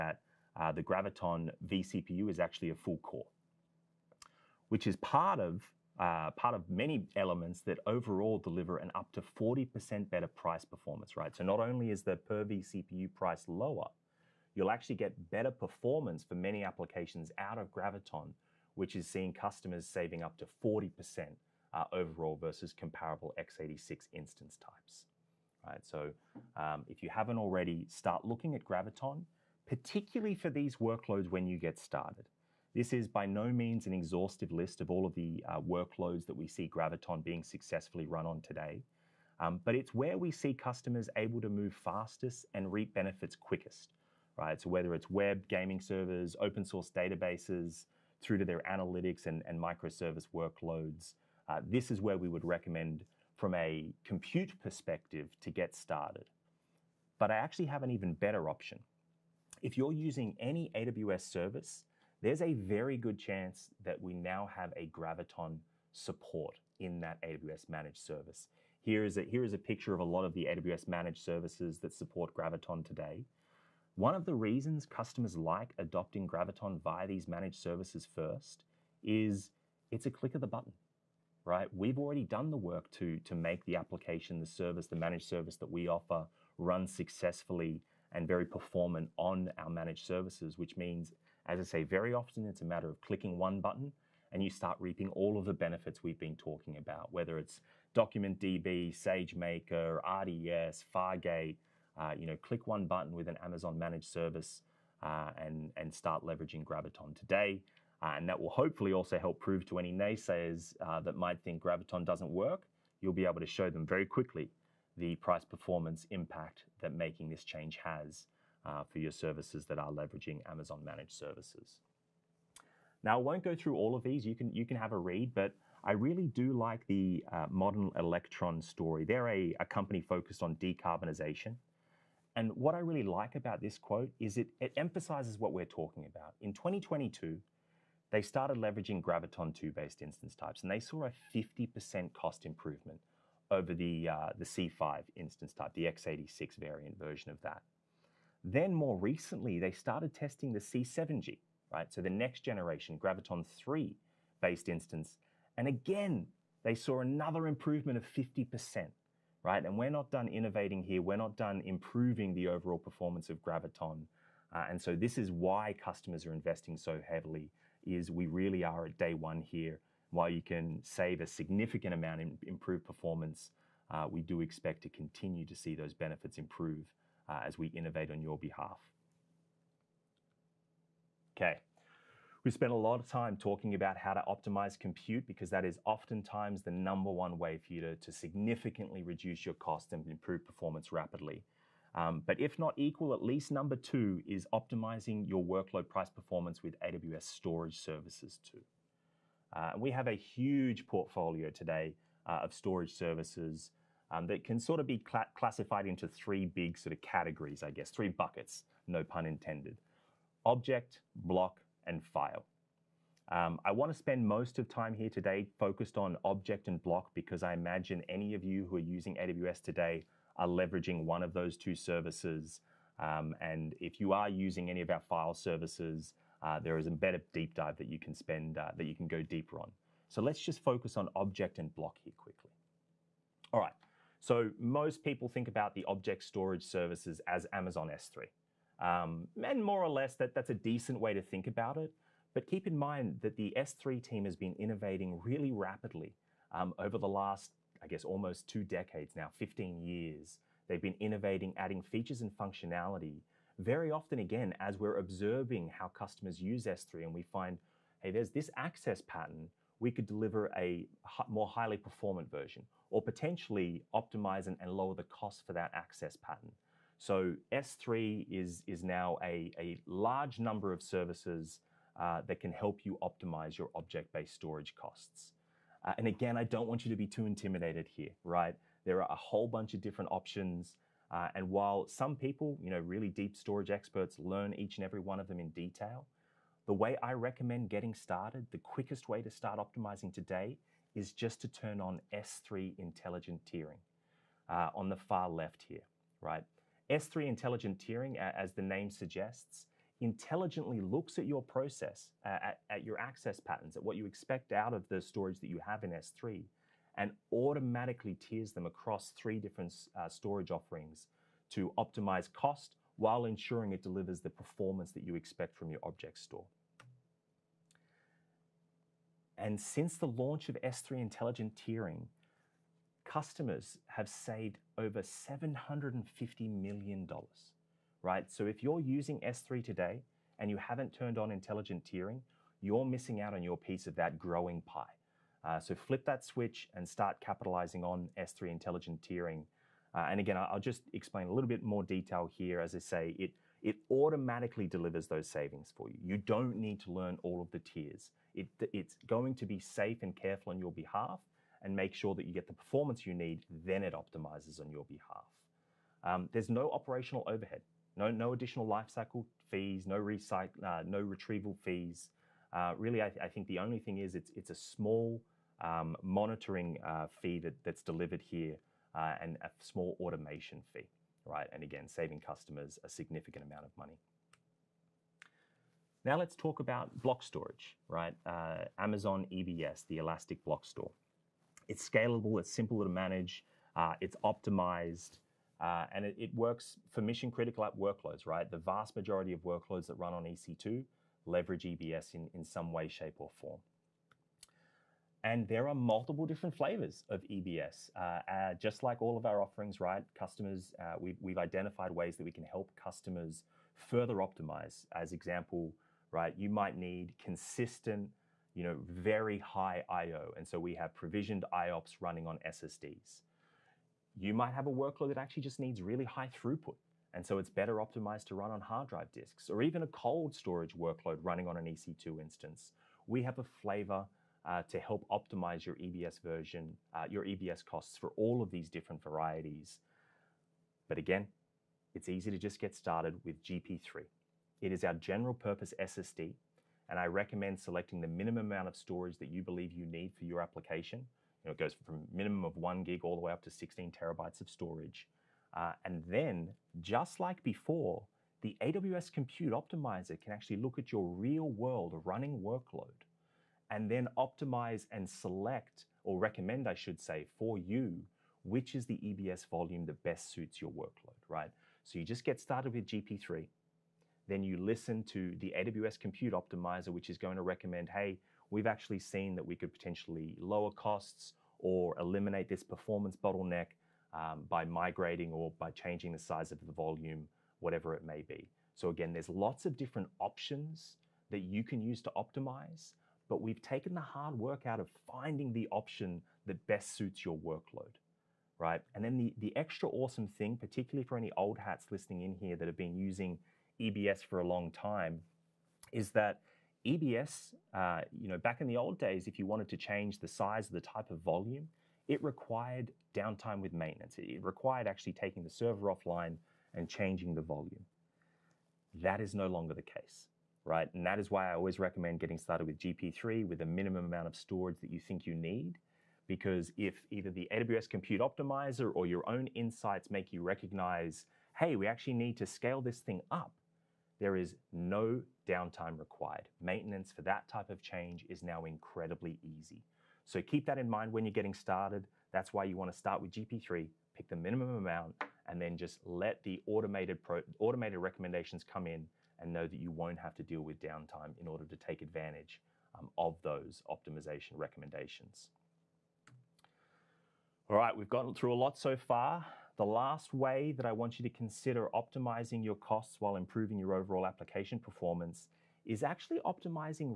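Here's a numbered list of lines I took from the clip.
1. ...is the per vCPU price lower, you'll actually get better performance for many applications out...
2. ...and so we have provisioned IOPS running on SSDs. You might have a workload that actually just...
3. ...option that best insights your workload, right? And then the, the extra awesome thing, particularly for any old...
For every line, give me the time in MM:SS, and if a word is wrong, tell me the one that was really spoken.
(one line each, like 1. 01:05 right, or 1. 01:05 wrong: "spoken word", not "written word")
1. 00:11 right
2. 06:50 right
3. 08:05 wrong: "suits", not "insights".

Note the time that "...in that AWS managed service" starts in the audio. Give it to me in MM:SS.
01:06.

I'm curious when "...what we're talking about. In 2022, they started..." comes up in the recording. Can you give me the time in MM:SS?
02:15.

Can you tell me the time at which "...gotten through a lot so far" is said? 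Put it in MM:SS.
09:08.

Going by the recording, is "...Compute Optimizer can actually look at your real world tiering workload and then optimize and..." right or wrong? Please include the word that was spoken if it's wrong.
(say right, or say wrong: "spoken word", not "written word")
wrong: "running", not "tiering".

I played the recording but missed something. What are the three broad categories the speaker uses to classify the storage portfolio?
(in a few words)
object, block, and file.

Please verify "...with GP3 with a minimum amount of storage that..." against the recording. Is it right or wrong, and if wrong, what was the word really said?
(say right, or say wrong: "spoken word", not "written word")
right.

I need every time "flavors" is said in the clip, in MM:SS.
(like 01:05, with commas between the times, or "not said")
06:36, 07:03.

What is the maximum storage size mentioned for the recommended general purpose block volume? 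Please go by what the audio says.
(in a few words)
16 terabytes.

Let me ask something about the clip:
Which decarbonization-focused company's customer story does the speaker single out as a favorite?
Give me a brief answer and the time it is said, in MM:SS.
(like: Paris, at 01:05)
Modern Electron, at 02:07.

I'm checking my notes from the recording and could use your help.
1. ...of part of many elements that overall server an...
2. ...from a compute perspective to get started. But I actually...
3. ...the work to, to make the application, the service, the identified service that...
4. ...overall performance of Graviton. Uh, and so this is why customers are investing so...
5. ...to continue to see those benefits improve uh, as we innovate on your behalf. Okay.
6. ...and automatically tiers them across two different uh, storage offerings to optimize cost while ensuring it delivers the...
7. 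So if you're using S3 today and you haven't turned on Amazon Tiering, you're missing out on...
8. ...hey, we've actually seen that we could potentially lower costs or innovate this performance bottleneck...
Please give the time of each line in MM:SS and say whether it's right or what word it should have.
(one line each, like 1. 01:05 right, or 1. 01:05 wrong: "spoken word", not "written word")
1. 00:05 wrong: "deliver", not "server"
2. 00:53 right
3. 01:22 wrong: "managed", not "identified"
4. 02:42 right
5. 02:54 right
6. 05:06 wrong: "three", not "two"
7. 05:28 wrong: "Intelligent", not "Amazon"
8. 07:47 wrong: "eliminate", not "innovate".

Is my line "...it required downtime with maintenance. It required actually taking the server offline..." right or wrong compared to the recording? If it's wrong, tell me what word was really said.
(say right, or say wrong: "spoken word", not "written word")
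right.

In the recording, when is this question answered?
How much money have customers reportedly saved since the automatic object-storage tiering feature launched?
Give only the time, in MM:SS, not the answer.
05:25.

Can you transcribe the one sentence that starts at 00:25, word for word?
So um, if you haven't already, start looking at Graviton, particularly for these workloads when you get started.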